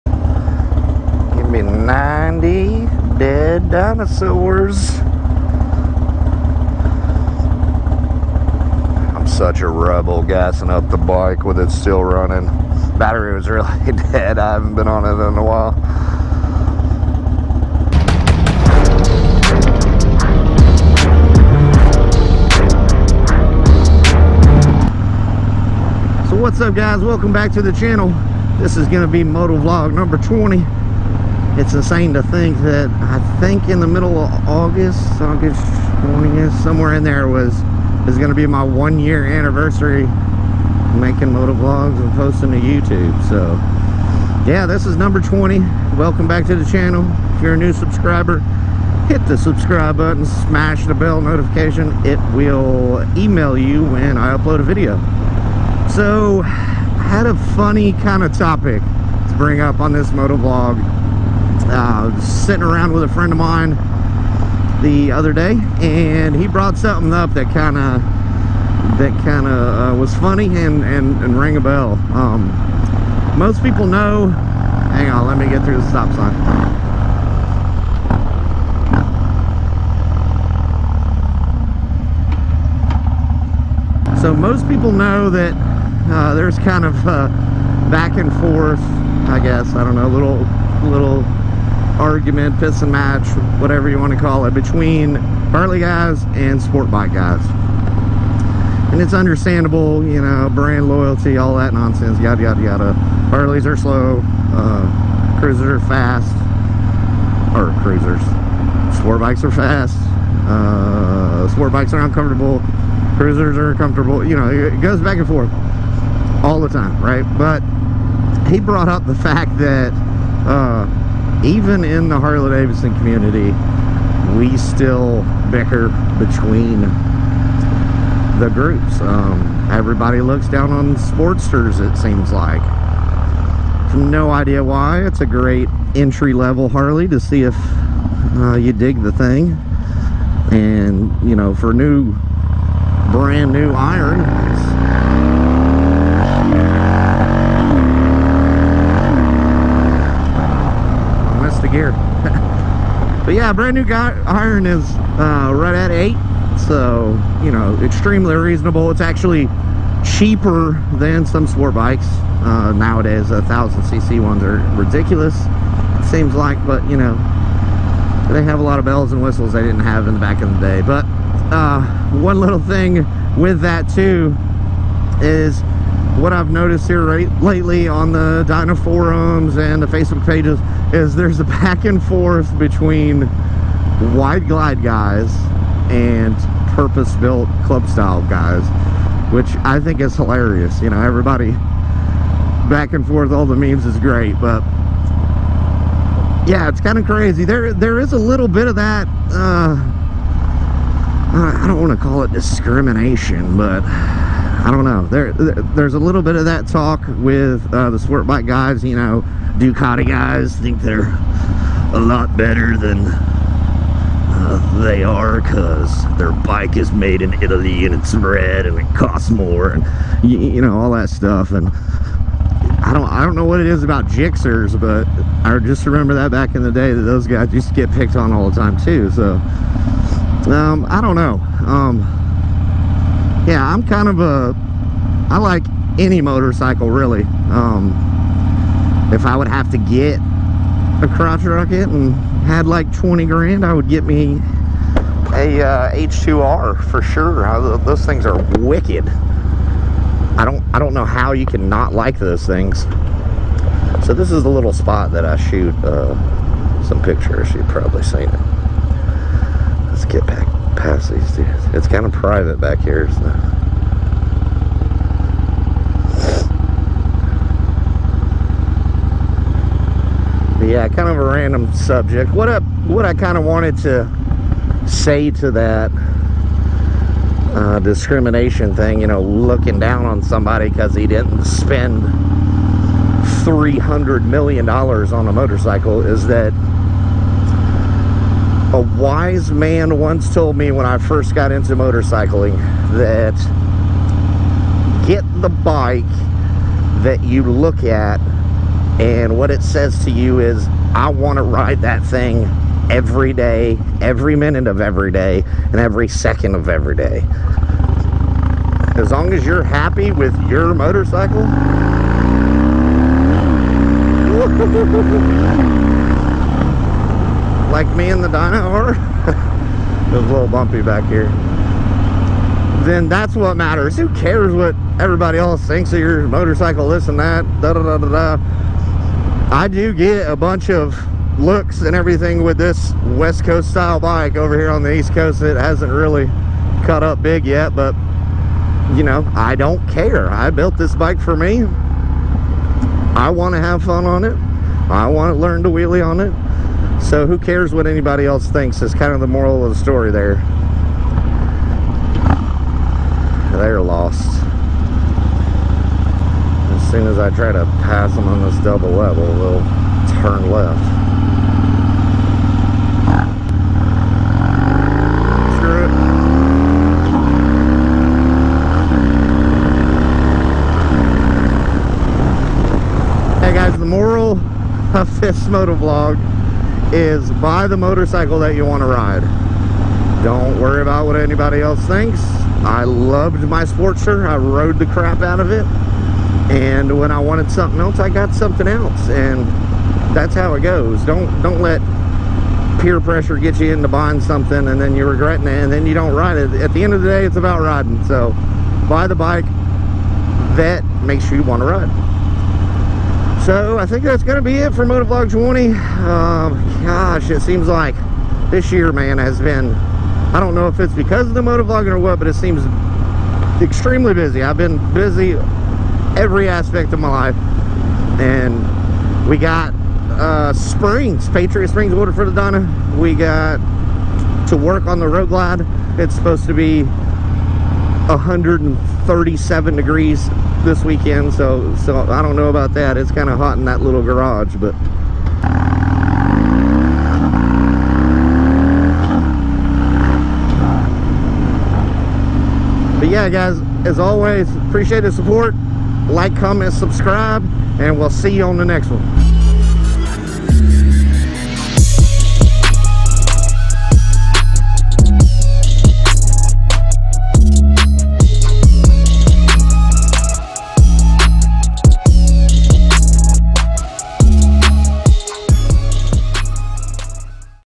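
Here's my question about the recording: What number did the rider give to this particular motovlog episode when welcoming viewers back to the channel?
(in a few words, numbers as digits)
20.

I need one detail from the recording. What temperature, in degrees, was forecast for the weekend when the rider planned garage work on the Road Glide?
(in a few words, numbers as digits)
137.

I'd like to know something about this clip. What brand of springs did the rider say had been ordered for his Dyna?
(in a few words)
Patriot Springs.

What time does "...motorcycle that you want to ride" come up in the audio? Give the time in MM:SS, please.
06:17.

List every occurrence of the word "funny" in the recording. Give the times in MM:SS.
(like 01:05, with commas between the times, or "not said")
00:57, 01:10.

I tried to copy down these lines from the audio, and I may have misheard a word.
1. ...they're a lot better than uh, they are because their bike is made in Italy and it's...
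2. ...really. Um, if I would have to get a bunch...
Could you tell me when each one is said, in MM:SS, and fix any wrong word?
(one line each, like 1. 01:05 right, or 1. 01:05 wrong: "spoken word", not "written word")
1. 03:30 right
2. 03:56 wrong: "crotch", not "bunch".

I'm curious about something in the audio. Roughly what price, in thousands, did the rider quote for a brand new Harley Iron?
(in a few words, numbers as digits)
8.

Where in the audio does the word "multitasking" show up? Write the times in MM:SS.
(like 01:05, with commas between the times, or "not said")
not said.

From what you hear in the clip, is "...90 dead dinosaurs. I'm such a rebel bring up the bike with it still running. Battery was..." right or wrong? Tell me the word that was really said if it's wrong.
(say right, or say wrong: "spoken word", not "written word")
wrong: "gassing", not "bring".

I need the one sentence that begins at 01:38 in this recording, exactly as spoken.
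And it's understandable, you know, brand loyalty, all that nonsense, yada, yada, yada.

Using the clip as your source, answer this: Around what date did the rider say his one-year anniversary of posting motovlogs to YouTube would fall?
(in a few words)
August 20th.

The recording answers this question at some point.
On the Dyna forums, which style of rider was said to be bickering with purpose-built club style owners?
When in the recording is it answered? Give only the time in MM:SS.
03:04.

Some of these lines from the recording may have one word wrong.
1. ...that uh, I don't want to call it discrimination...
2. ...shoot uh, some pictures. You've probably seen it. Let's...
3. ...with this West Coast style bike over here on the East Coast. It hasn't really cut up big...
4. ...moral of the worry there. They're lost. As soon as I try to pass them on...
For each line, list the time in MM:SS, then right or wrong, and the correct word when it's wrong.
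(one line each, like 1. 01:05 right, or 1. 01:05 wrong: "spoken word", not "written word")
1. 03:18 right
2. 04:15 right
3. 05:32 right
4. 05:49 wrong: "story", not "worry".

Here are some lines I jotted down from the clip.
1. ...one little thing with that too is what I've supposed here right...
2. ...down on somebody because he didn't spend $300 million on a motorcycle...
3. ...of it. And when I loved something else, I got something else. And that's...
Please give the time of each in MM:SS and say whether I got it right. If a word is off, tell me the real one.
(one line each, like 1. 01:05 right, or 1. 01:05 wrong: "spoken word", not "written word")
1. 02:52 wrong: "noticed", not "supposed"
2. 04:39 right
3. 06:25 wrong: "wanted", not "loved".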